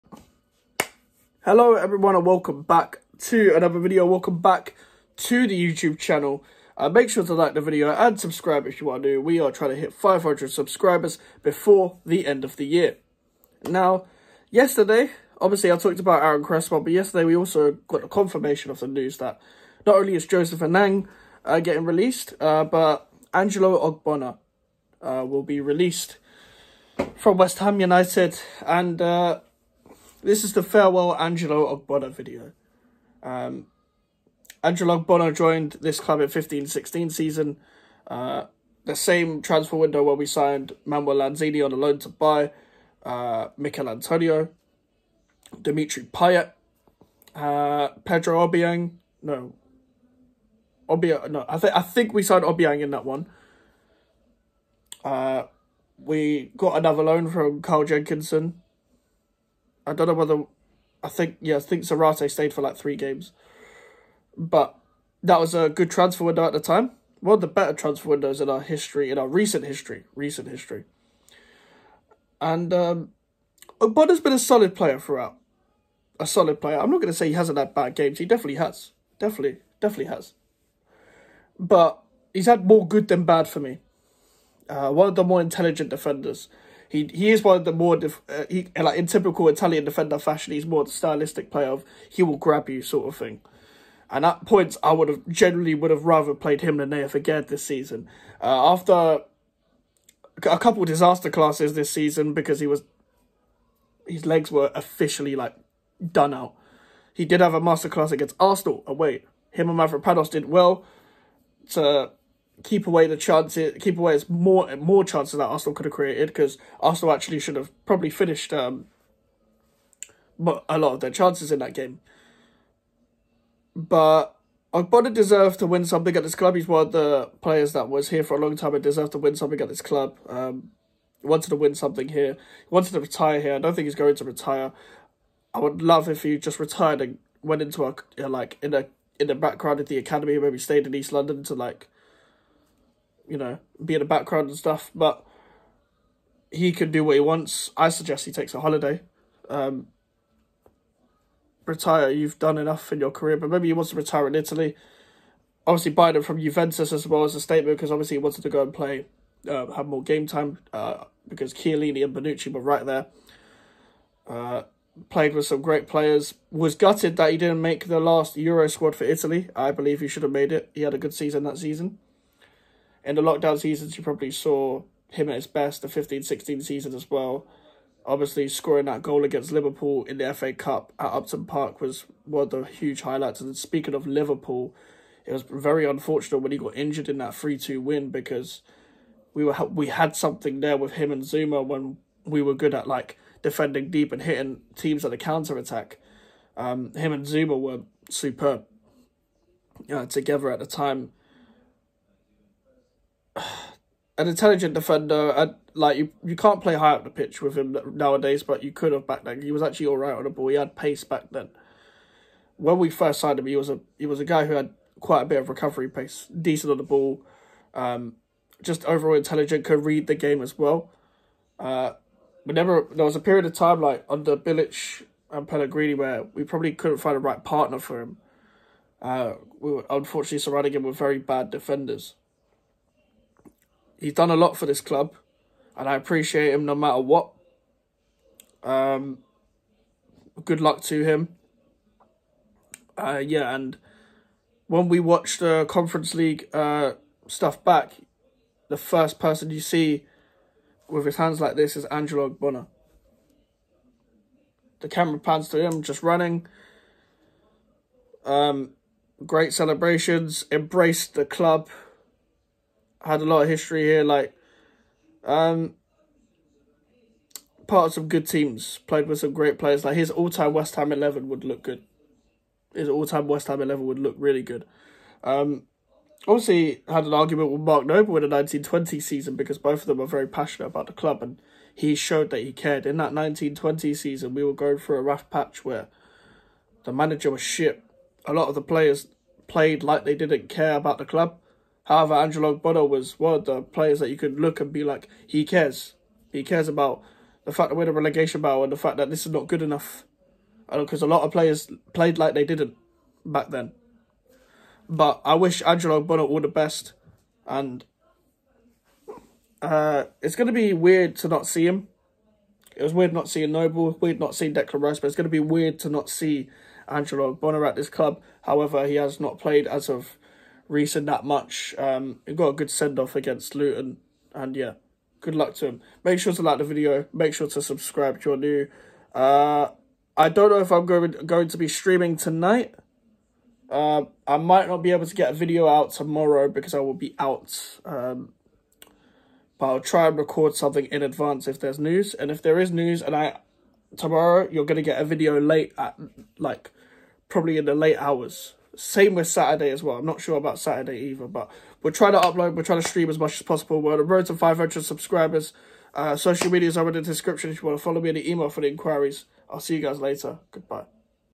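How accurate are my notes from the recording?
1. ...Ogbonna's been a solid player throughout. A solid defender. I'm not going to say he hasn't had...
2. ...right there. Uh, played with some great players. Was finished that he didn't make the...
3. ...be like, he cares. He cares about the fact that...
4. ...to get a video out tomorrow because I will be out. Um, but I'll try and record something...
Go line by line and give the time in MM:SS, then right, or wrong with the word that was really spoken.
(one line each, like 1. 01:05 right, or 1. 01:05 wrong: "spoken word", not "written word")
1. 01:13 wrong: "player", not "defender"
2. 02:42 wrong: "gutted", not "finished"
3. 04:54 right
4. 05:35 right.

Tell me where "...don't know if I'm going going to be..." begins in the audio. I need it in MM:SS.
05:30.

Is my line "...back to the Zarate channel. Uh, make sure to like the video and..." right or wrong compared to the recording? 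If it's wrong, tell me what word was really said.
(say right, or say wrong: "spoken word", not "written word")
wrong: "YouTube", not "Zarate".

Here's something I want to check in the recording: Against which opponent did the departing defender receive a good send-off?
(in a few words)
Luton.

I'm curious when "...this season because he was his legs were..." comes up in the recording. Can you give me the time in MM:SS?
01:41.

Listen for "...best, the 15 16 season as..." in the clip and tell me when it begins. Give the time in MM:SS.
02:55.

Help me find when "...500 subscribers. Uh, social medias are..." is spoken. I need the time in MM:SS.
05:54.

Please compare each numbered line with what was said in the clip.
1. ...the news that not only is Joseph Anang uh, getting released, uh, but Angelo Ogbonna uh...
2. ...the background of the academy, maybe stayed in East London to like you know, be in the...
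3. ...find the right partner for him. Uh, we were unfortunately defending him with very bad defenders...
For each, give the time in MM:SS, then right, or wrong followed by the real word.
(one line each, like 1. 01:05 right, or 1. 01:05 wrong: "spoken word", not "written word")
1. 00:18 right
2. 02:19 right
3. 03:46 wrong: "surrounding", not "defending".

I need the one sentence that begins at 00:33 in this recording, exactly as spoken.
Um, Angelo Ogbonna joined this club in 15-16 season.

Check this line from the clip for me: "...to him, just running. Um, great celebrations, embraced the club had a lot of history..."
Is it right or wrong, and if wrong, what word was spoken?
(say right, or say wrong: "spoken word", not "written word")
right.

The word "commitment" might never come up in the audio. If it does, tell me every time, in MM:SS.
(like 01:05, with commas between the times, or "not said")
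not said.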